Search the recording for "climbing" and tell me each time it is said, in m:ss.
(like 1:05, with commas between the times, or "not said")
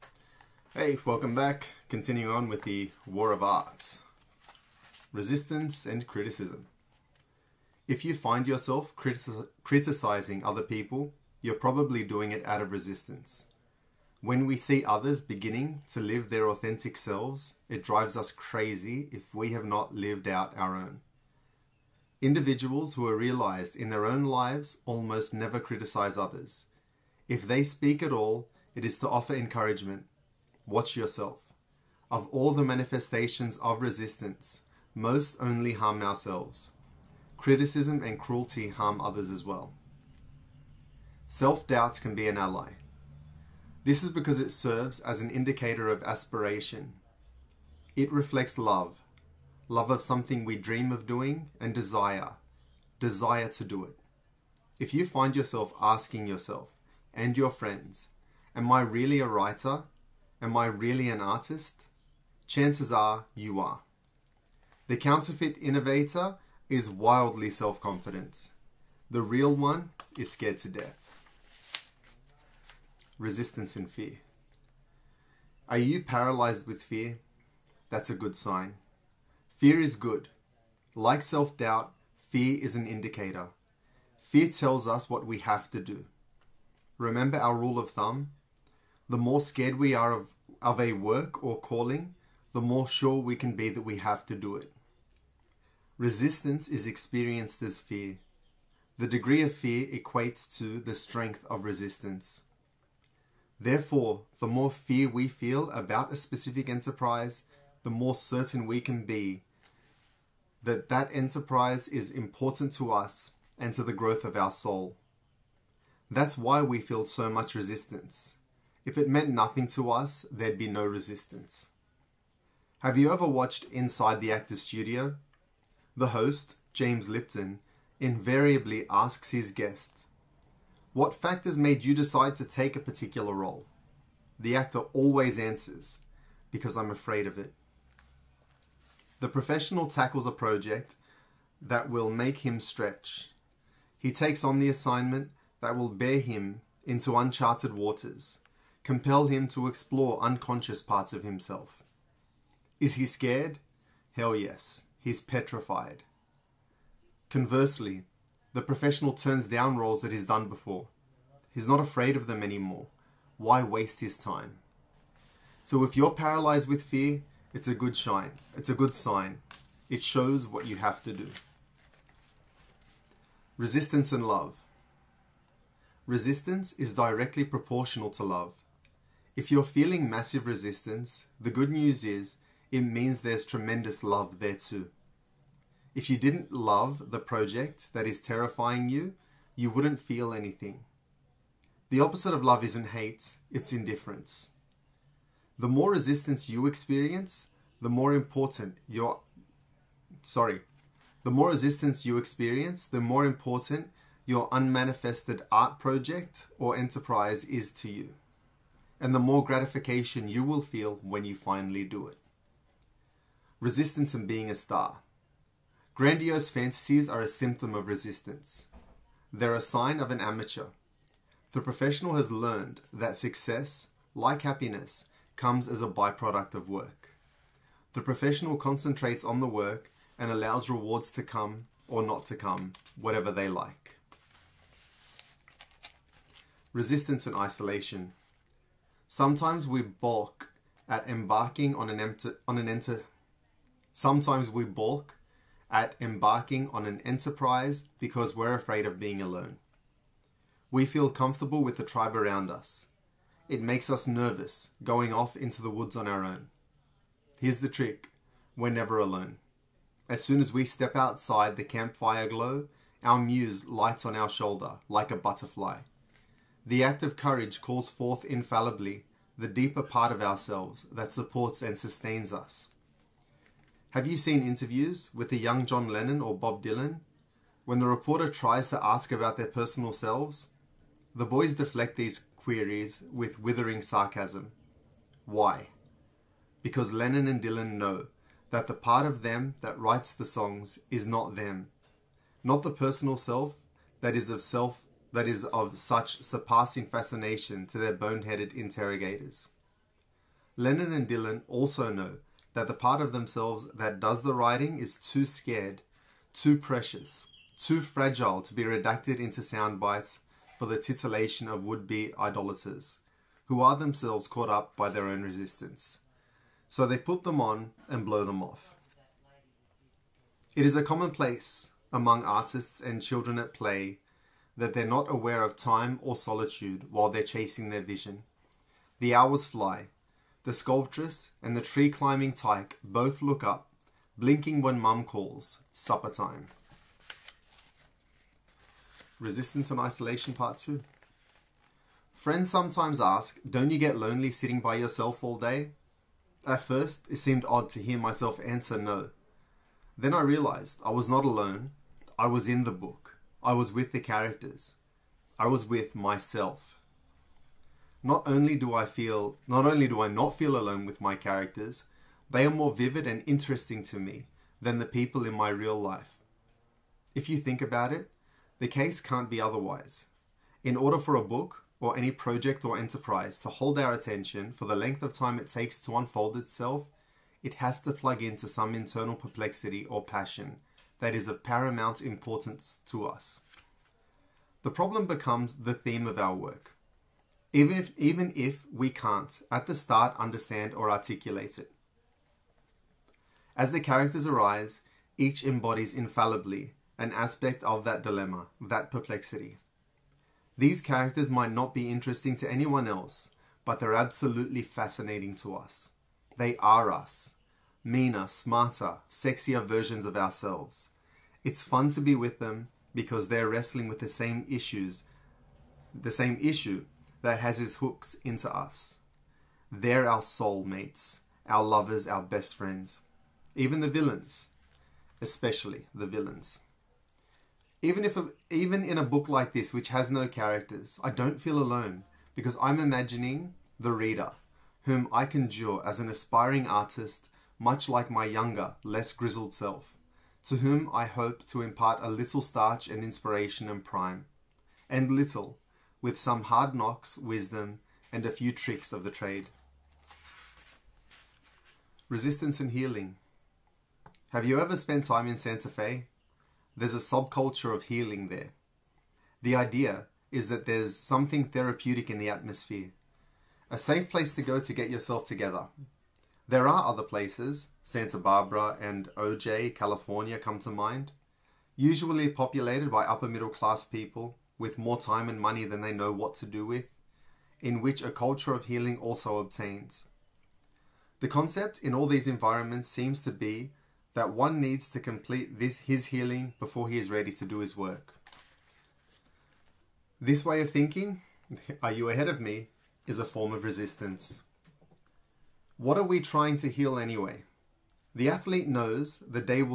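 5:31.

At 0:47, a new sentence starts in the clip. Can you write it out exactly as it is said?
It reflects love, love of something we dream of doing and desire, desire to do it.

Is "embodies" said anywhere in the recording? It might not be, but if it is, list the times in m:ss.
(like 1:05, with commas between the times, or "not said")
6:35.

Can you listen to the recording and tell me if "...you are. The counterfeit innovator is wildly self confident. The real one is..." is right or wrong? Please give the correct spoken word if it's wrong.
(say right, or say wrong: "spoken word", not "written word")
right.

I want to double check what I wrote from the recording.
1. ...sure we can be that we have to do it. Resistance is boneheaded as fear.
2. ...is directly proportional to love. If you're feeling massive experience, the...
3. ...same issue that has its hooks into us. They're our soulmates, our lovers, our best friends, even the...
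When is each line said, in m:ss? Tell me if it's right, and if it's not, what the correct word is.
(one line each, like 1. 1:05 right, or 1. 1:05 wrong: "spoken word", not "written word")
1. 1:32 wrong: "experienced", not "boneheaded"
2. 2:56 wrong: "resistance", not "experience"
3. 6:56 right.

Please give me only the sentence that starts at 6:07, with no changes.
If you think about it, the case can't be otherwise.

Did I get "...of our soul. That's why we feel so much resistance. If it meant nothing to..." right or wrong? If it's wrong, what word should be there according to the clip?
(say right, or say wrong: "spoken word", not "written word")
right.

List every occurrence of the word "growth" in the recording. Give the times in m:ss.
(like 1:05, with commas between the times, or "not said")
1:53.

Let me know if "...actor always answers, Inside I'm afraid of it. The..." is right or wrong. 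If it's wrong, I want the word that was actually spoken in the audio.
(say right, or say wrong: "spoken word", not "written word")
wrong: "Because", not "Inside".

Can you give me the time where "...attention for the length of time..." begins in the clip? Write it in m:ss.
6:13.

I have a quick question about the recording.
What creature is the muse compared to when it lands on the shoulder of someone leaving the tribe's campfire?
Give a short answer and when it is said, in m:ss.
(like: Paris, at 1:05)
A butterfly, at 4:25.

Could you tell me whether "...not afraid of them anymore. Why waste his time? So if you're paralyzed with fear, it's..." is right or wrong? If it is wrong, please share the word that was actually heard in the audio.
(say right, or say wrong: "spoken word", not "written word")
right.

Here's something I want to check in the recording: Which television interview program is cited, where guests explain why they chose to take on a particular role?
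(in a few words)
Inside the Actor Studio.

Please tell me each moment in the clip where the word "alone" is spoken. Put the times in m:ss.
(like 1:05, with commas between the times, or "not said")
4:09, 4:18, 5:51, 6:00, 7:11.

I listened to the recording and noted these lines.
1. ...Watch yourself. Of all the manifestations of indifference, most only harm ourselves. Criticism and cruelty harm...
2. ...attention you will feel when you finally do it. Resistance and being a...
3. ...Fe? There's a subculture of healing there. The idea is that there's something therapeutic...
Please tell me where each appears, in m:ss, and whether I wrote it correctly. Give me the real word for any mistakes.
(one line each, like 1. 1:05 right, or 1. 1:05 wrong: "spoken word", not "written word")
1. 0:30 wrong: "resistance", not "indifference"
2. 3:29 wrong: "gratification", not "attention"
3. 7:35 right.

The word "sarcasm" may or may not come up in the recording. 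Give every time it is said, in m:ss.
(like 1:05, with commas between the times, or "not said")
4:43.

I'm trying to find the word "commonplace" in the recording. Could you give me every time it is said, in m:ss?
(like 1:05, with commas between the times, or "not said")
5:20.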